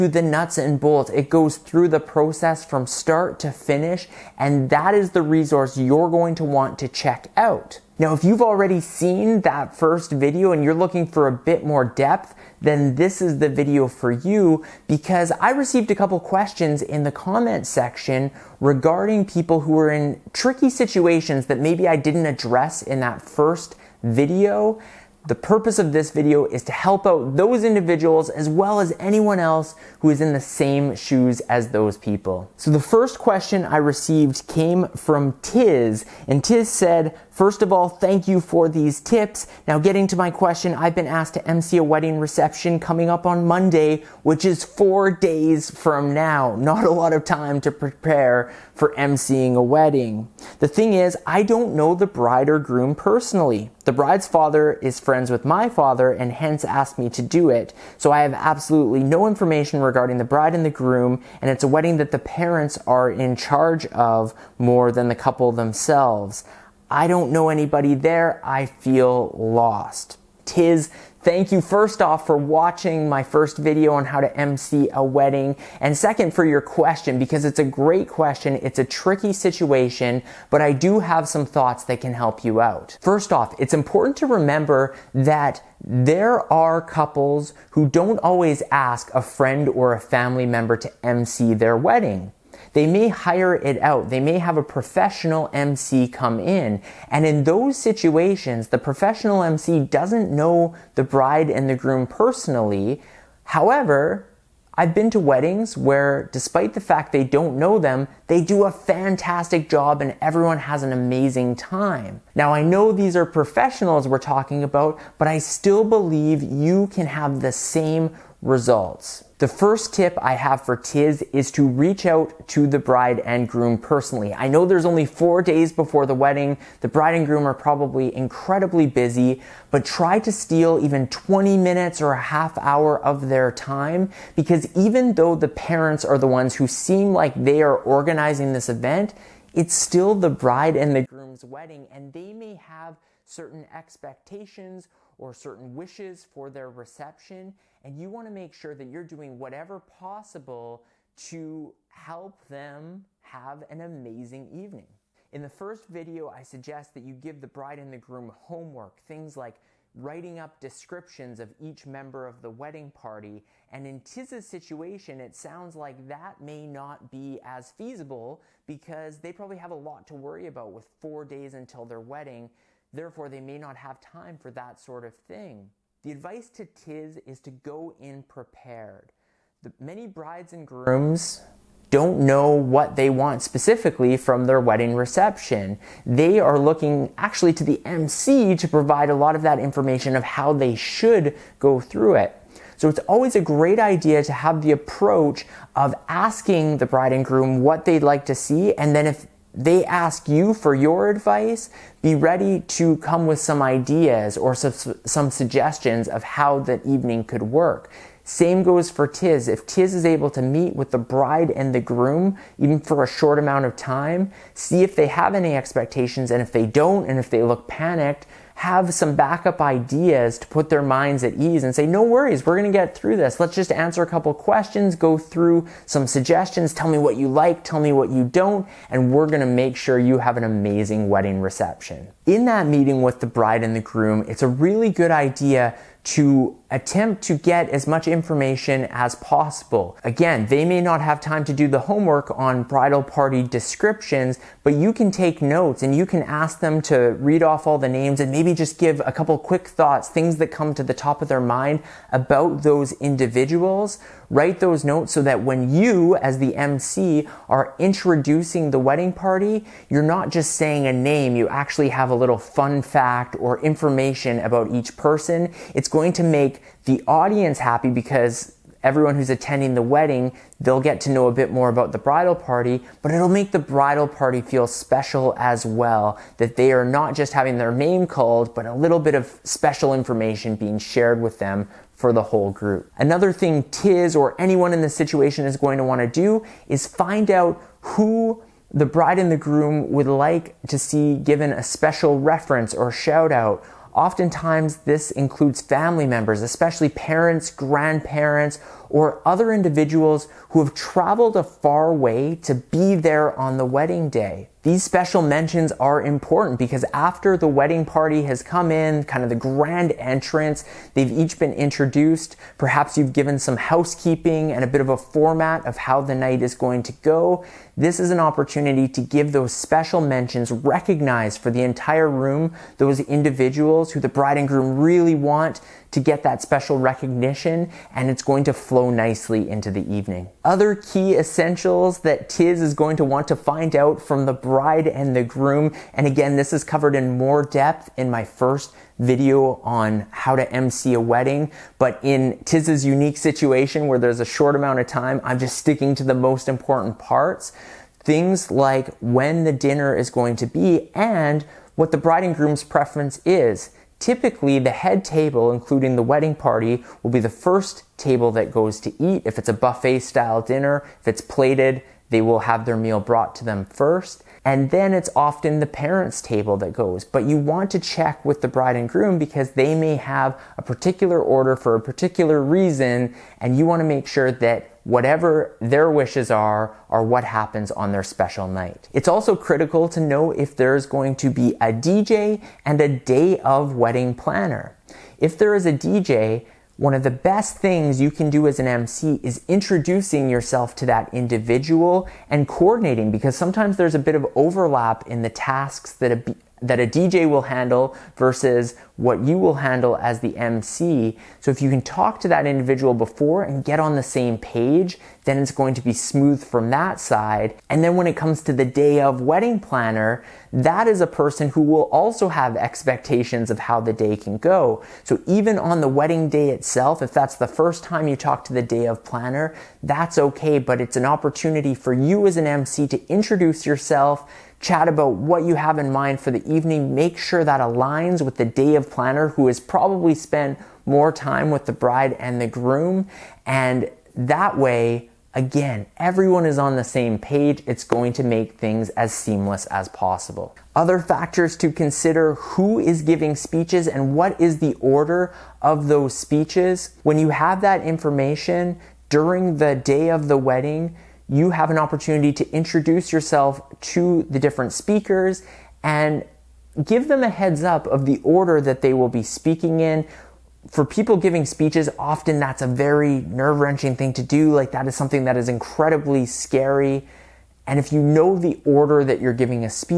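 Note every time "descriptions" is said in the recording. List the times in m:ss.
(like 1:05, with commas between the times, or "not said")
2:40, 4:03.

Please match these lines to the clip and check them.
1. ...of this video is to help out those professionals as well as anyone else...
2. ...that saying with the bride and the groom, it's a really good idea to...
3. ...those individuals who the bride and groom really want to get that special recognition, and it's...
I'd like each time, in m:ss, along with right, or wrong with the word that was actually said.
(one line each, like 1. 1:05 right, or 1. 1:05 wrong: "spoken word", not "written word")
1. 0:25 wrong: "individuals", not "professionals"
2. 3:52 wrong: "meeting", not "saying"
3. 5:22 right.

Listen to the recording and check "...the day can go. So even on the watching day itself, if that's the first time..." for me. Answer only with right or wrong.
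wrong.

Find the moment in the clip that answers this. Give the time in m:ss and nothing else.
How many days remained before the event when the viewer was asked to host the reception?
0:44.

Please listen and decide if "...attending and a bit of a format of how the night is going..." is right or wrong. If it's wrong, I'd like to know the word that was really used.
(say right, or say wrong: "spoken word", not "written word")
wrong: "housekeeping", not "attending".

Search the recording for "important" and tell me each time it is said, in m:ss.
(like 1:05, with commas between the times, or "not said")
1:23, 5:06, 5:46.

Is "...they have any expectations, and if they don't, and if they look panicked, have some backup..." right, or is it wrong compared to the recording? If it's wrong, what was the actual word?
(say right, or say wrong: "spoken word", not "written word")
right.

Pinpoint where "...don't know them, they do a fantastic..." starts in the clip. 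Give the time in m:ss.
1:47.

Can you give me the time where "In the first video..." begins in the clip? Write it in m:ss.
2:35.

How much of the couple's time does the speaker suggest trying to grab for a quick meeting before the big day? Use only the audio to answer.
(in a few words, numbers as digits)
20 minutes.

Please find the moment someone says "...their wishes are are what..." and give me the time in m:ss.
6:15.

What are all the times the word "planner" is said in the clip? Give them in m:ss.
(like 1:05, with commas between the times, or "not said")
6:24, 6:49, 6:59, 7:08.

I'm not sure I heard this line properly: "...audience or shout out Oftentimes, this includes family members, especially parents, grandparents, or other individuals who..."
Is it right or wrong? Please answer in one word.
wrong.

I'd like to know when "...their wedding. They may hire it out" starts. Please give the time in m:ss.
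1:31.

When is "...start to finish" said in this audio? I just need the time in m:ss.
0:02.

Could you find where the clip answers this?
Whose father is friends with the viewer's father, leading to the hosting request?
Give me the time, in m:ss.
0:53.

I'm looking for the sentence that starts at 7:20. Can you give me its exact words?
Other factors to consider who is giving speeches and what is the order of those speeches.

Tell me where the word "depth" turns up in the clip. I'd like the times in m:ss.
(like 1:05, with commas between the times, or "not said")
0:11, 5:37.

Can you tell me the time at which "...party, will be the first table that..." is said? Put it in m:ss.
5:56.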